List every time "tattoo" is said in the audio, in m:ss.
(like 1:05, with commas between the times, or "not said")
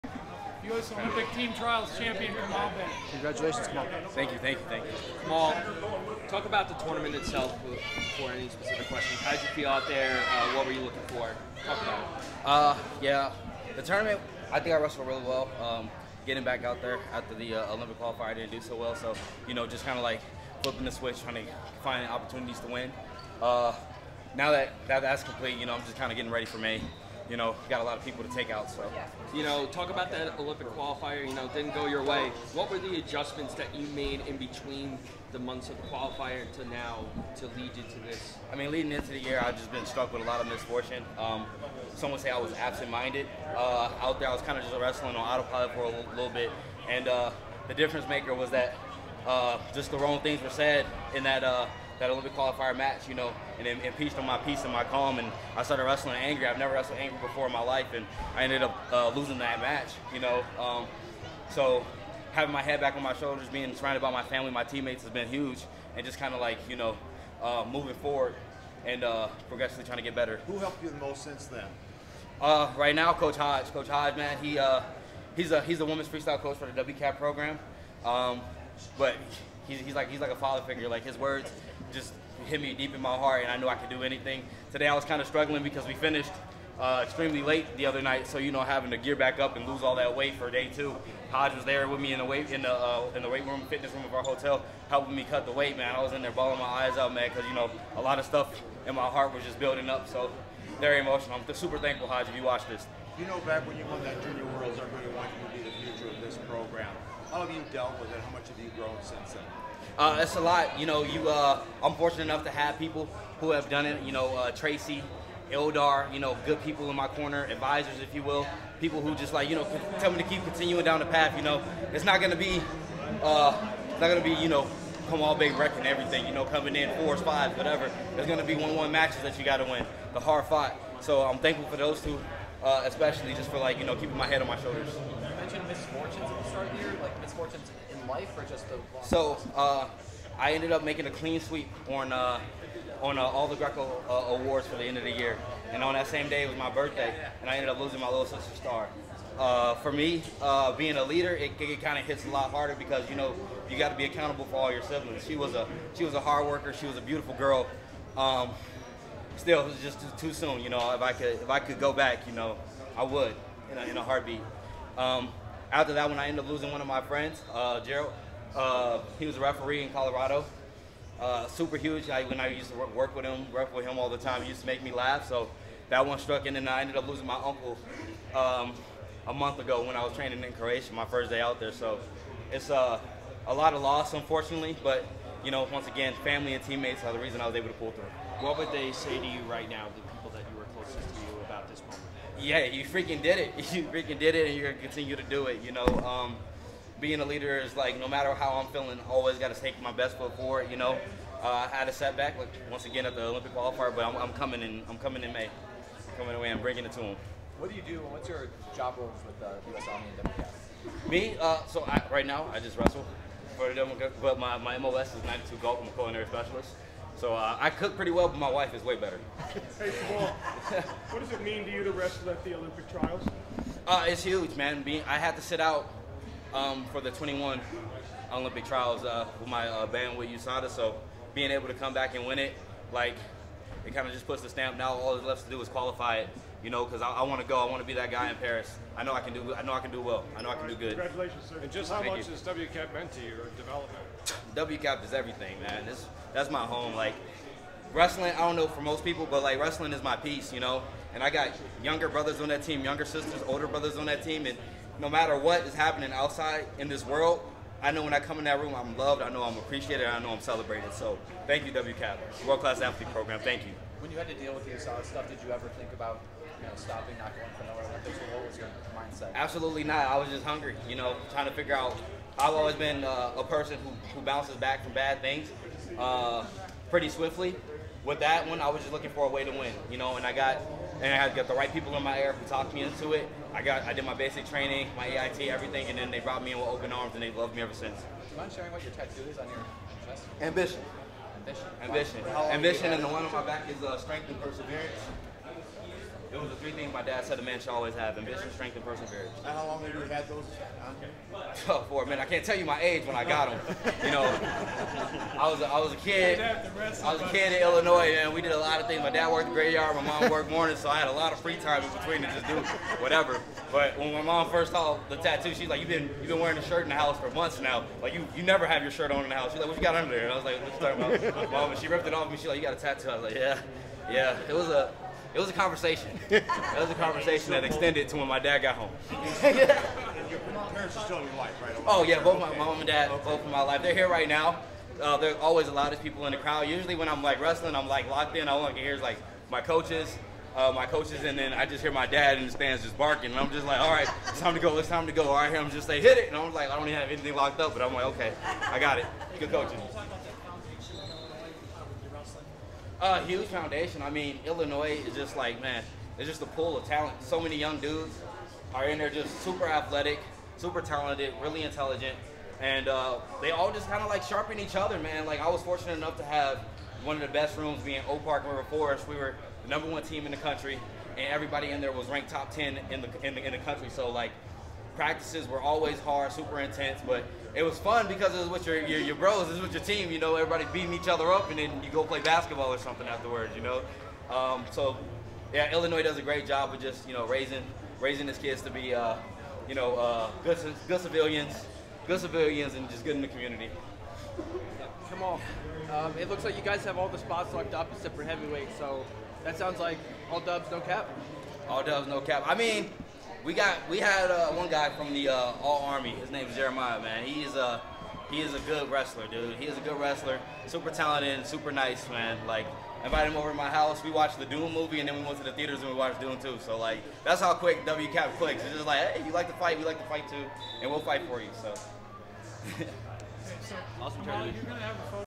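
4:48, 5:15, 5:22.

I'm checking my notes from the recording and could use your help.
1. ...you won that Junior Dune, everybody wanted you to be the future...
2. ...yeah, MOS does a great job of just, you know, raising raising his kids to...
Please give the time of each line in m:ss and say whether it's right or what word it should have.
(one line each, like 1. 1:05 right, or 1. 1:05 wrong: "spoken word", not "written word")
1. 1:43 wrong: "Worlds", not "Dune"
2. 6:25 wrong: "Illinois", not "MOS".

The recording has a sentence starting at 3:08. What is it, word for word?
What would they say to you right now, the people that you were closest to you, about this moment?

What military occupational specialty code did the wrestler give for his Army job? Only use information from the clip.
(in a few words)
92 Golf.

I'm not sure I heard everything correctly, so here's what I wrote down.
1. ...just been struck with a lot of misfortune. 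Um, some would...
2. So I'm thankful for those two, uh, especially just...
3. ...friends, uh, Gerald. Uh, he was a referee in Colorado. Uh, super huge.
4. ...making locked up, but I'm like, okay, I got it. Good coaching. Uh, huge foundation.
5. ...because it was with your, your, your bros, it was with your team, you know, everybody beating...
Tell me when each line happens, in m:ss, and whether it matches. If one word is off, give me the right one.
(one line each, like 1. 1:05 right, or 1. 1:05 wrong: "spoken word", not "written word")
1. 0:39 right
2. 2:10 right
3. 2:47 right
4. 5:47 wrong: "anything", not "making"
5. 6:18 right.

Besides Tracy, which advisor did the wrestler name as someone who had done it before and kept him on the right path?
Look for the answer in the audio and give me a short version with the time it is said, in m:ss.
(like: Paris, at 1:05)
Eldar, at 1:55.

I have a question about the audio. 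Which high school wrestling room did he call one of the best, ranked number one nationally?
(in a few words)
Oak Park River Forest.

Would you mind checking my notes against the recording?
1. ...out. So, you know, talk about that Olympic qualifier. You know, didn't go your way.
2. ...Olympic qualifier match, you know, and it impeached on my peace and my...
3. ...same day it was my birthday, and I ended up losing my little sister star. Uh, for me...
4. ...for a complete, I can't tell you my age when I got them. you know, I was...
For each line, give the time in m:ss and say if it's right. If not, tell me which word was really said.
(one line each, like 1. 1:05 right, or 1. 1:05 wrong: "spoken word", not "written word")
1. 0:28 right
2. 0:52 right
3. 2:26 right
4. 5:01 wrong: "minute", not "complete".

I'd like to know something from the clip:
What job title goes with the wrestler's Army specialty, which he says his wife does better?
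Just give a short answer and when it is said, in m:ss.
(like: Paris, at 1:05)
Culinary specialist, at 3:35.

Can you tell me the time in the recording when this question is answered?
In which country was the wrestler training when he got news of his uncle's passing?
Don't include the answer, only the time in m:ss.
3:00.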